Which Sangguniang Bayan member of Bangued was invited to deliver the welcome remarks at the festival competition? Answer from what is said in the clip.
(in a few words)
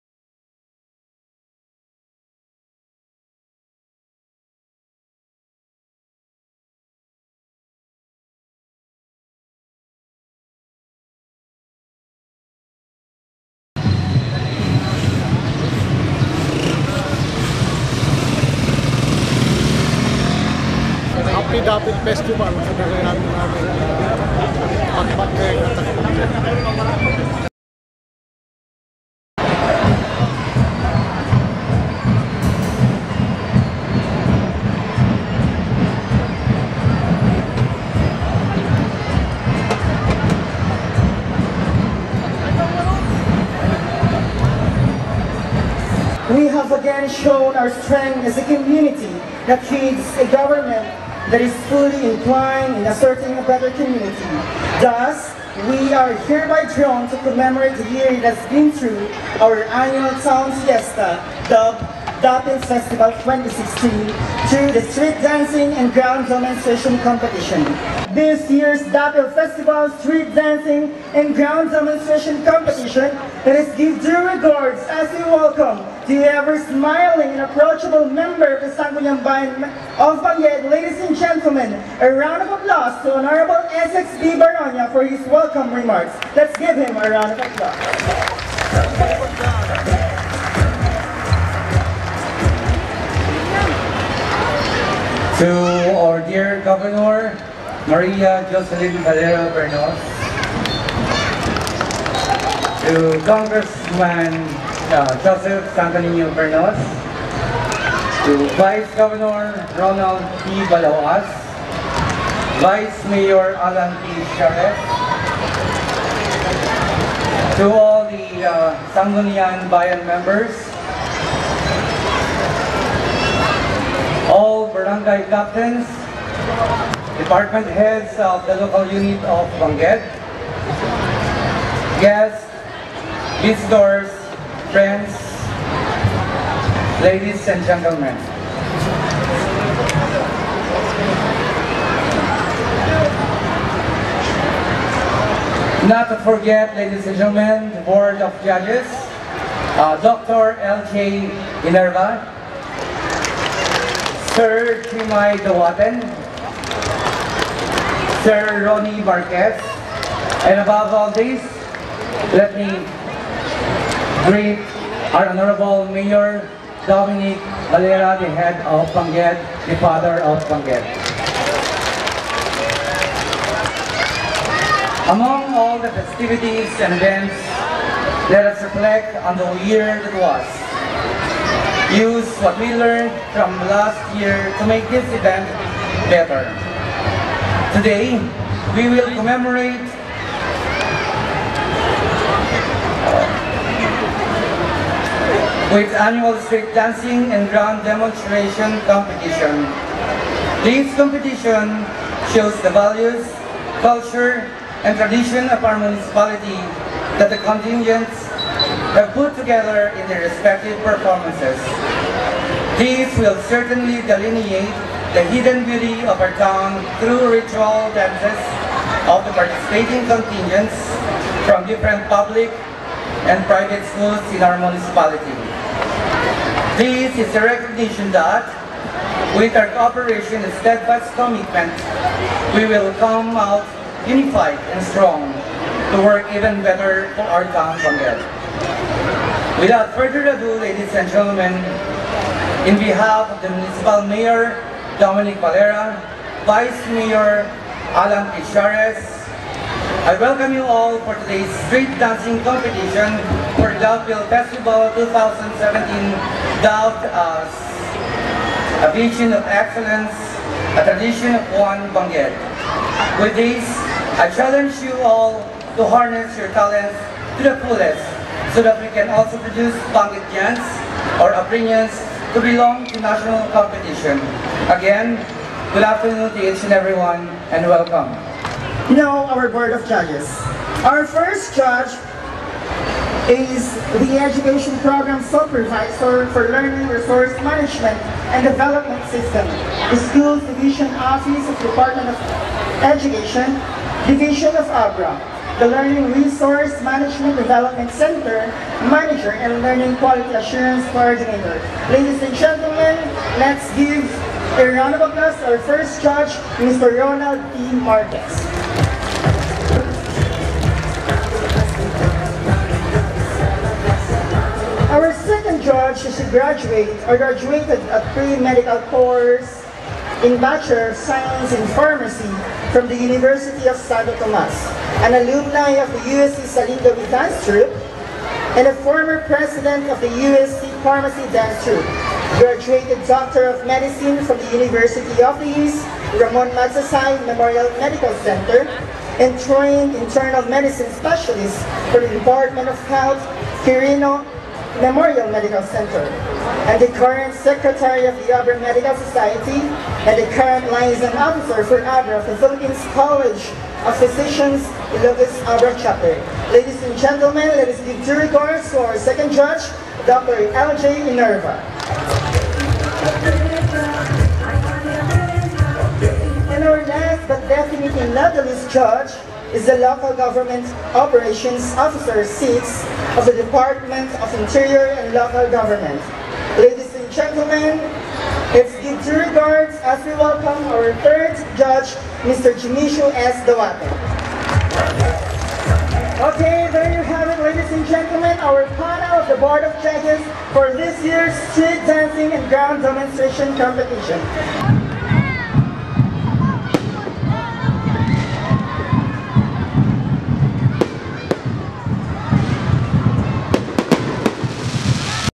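Essex B. Baronia.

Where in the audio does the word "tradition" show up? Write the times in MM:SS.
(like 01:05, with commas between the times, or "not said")
03:24, 04:20.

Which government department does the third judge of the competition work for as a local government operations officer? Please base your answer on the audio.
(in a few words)
Department of Interior and Local Government.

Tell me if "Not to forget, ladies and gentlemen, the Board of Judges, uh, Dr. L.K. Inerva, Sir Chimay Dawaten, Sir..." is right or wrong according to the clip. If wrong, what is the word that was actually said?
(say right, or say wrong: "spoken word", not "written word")
right.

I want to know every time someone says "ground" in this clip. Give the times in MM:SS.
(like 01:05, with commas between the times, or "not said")
01:05, 01:11, 03:17, 06:32.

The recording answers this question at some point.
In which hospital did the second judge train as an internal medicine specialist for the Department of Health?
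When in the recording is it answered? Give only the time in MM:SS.
05:43.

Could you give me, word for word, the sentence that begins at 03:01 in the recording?
Use what we learned from last year to make this event better.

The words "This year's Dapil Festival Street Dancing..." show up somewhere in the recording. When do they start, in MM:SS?
01:08.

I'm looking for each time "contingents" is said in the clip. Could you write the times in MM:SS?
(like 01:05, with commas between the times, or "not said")
03:27, 03:40.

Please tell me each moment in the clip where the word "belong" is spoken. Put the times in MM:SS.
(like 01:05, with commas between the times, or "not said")
04:32.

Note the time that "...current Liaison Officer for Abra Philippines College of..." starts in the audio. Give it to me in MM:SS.
05:50.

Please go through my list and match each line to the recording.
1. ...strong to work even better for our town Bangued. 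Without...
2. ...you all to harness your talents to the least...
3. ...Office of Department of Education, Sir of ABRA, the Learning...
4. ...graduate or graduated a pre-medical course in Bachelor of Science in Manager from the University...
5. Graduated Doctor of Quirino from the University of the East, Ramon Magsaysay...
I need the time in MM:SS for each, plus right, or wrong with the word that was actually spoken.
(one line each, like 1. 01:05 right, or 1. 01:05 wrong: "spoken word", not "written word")
1. 03:54 right
2. 04:24 wrong: "fullest", not "least"
3. 04:50 wrong: "Division", not "Sir"
4. 05:16 wrong: "Pharmacy", not "Manager"
5. 05:32 wrong: "Medicine", not "Quirino".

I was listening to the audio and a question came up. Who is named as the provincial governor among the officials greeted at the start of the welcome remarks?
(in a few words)
Maria Jocelyn Valera Bernos.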